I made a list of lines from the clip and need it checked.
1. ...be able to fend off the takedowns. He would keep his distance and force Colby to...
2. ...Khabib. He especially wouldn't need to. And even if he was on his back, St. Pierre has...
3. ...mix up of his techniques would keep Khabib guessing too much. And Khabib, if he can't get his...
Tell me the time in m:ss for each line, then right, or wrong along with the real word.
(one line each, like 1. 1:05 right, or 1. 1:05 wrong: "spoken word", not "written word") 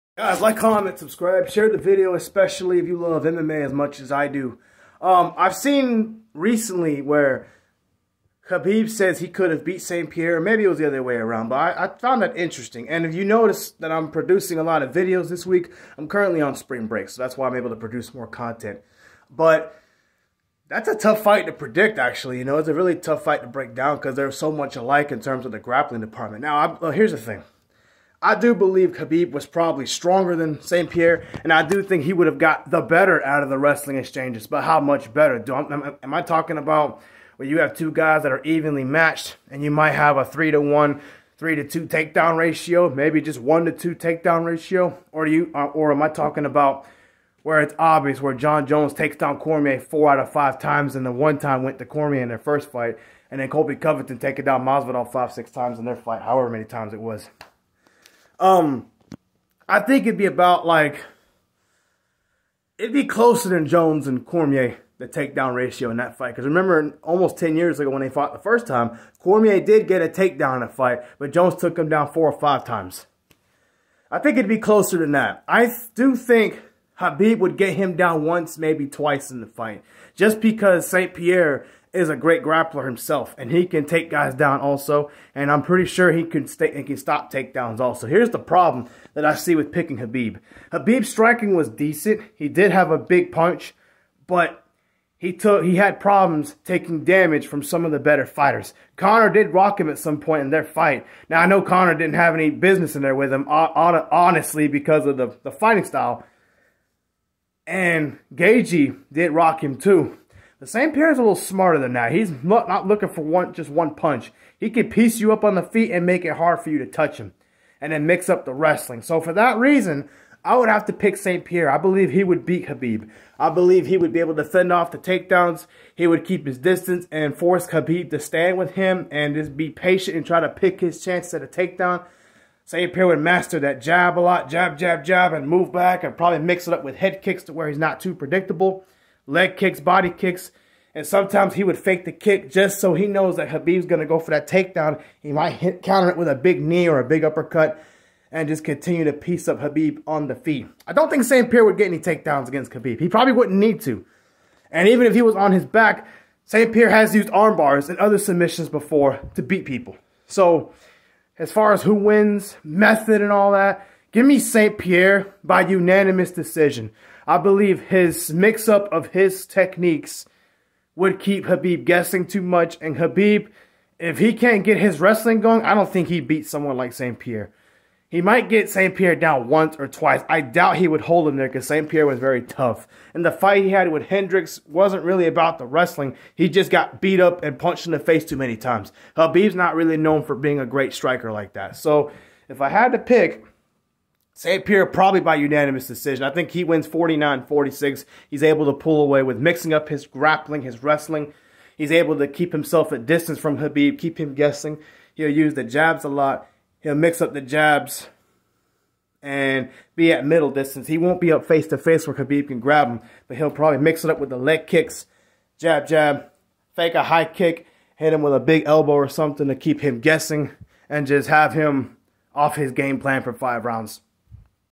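1. 2:04 wrong: "Khabib", not "Colby"
2. 2:32 wrong: "probably", not "especially"
3. 2:48 right.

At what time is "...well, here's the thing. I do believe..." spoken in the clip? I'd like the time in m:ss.
0:26.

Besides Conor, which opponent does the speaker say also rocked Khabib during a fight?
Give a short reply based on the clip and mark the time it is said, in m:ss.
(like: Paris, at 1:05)
Gaethje, at 1:48.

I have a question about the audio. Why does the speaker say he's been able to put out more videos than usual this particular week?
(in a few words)
Spring break.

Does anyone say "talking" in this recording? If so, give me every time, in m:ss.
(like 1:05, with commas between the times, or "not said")
0:36, 0:46.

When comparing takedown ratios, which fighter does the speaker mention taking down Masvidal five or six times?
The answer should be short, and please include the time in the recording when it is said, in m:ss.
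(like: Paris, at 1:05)
Colby Covington, at 0:53.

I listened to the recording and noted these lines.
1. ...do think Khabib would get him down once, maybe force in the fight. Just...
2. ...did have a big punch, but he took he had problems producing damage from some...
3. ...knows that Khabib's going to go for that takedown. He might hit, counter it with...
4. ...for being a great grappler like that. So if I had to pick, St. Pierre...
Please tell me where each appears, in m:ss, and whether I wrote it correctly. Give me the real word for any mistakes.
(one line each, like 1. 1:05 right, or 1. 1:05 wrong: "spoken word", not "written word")
1. 1:15 wrong: "twice", not "force"
2. 1:32 wrong: "taking", not "producing"
3. 2:23 right
4. 3:10 wrong: "striker", not "grappler".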